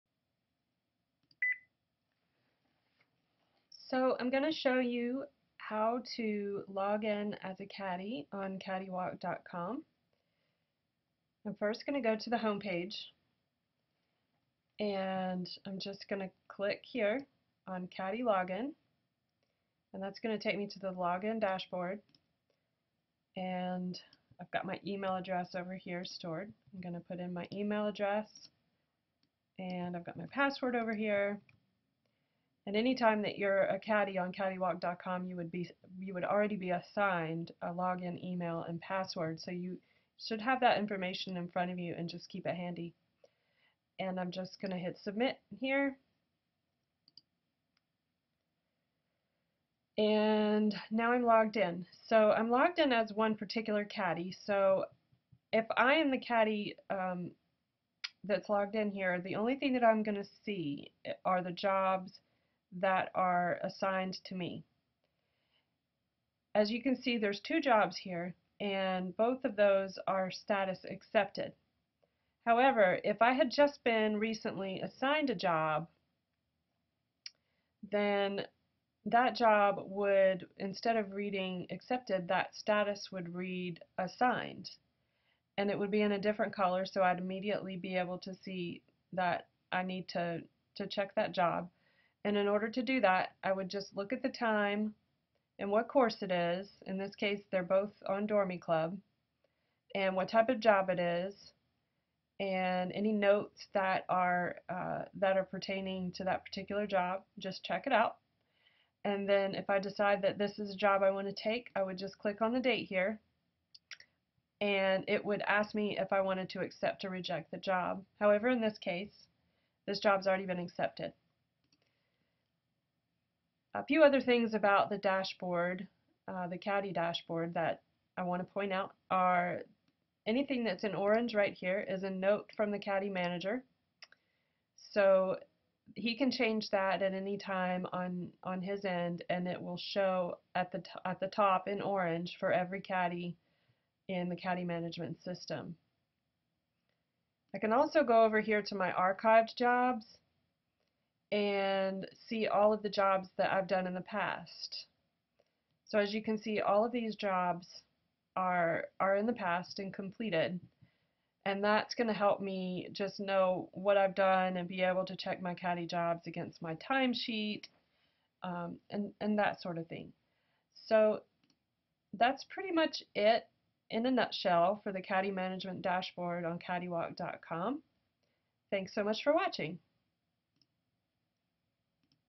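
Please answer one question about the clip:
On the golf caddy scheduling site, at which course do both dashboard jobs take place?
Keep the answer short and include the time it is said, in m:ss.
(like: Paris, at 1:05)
Dormie Club, at 1:38.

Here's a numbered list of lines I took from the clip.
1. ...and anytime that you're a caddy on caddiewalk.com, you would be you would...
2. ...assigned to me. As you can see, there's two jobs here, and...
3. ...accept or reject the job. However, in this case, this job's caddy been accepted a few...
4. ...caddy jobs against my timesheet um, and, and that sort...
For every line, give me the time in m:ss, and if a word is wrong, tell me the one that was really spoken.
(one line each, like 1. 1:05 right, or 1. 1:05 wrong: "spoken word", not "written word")
1. 0:32 right
2. 1:03 right
3. 1:56 wrong: "already", not "caddy"
4. 2:45 right.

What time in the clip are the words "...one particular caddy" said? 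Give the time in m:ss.
0:53.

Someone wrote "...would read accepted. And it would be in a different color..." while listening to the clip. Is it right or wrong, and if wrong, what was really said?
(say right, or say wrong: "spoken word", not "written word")
wrong: "assigned", not "accepted".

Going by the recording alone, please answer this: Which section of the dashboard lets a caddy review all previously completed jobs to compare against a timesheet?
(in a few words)
archived jobs.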